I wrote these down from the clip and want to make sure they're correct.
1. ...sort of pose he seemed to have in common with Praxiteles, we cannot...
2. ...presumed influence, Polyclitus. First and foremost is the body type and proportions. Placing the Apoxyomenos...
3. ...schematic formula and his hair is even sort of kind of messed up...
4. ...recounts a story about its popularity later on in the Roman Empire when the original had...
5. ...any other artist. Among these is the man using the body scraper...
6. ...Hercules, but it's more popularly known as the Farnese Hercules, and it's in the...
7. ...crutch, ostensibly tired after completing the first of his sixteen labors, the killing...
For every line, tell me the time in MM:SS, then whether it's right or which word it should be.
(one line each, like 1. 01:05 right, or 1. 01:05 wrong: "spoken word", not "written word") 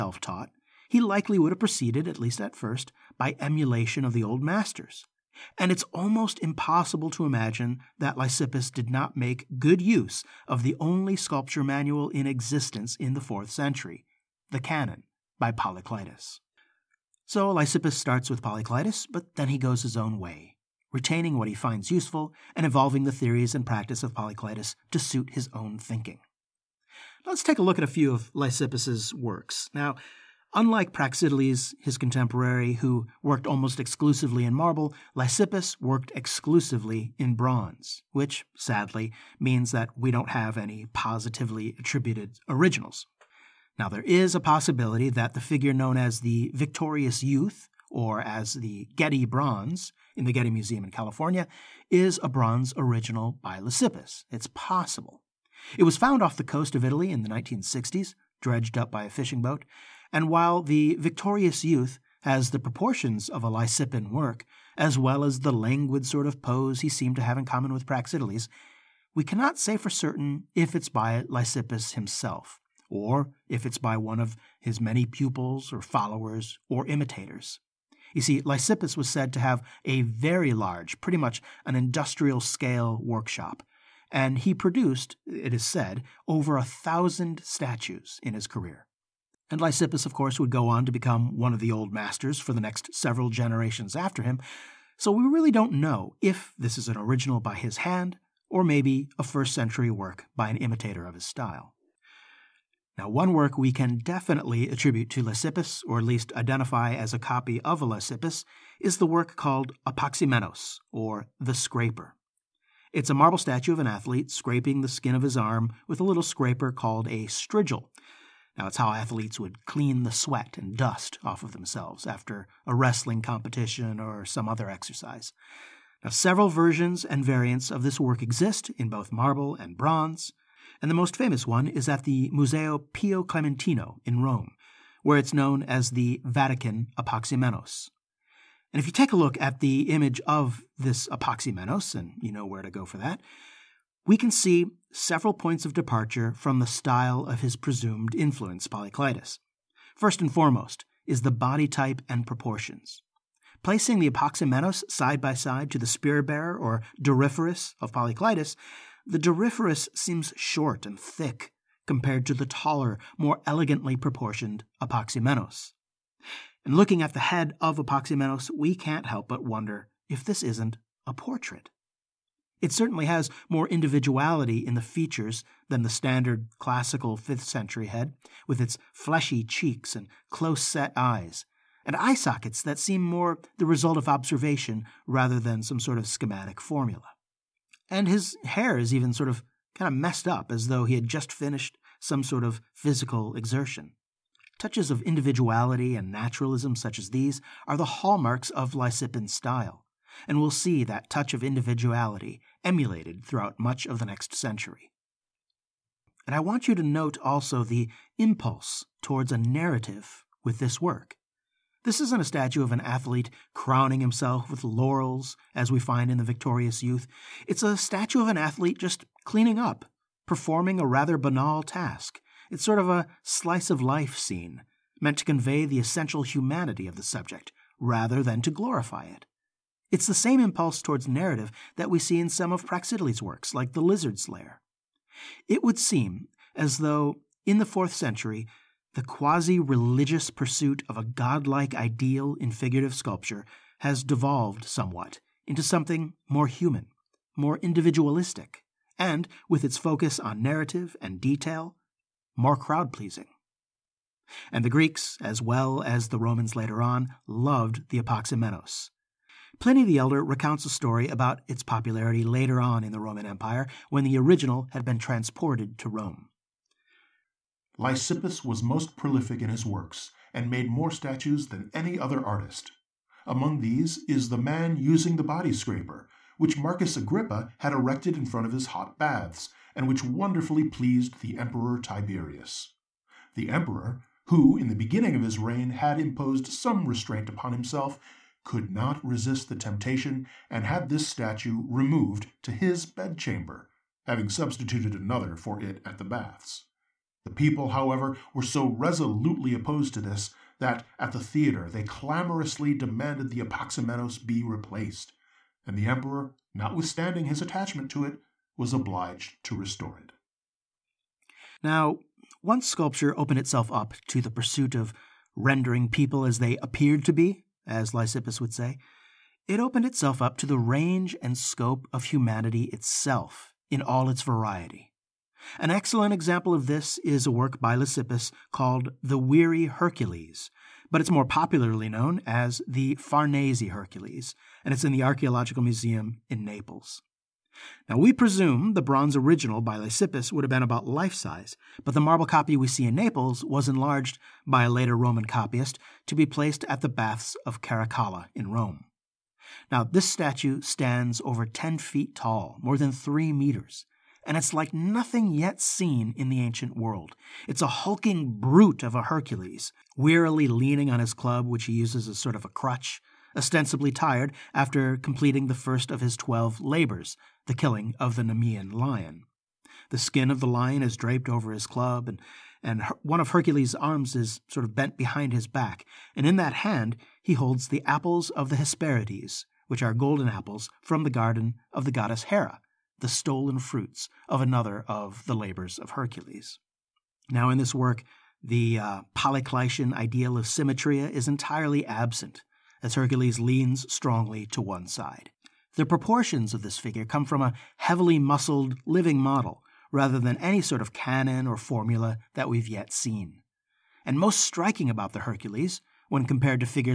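1. 01:06 right
2. 02:27 right
3. 03:06 right
4. 04:20 right
5. 04:31 right
6. 05:29 right
7. 06:02 wrong: "twelve", not "sixteen".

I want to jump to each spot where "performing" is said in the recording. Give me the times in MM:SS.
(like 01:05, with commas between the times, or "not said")
03:40.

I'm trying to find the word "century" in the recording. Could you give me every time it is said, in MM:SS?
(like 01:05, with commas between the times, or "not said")
00:13, 01:39, 02:57, 03:24, 03:57.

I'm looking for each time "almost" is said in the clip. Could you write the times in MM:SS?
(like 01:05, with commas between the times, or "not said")
00:05, 00:33.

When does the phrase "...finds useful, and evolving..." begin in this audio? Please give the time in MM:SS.
00:21.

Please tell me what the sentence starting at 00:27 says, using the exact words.
Let's take a look at a few of Lysippus's works.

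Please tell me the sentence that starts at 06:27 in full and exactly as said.
Now, in this work, the uh, ideal of symmetria is entirely absent, as Hercules leans strongly to one side.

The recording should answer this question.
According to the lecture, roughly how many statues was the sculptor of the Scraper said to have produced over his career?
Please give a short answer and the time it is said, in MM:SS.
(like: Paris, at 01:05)
over 1000, at 01:26.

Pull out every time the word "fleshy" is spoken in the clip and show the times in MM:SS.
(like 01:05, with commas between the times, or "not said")
02:58.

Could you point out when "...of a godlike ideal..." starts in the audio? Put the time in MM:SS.
04:00.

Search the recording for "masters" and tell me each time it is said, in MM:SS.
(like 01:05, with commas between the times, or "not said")
00:04, 01:31.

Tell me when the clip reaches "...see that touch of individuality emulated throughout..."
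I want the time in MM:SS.
03:20.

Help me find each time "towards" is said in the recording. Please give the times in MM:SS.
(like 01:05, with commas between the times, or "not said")
03:29, 03:50.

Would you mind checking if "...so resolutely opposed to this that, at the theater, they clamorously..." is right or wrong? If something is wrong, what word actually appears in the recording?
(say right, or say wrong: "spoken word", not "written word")
right.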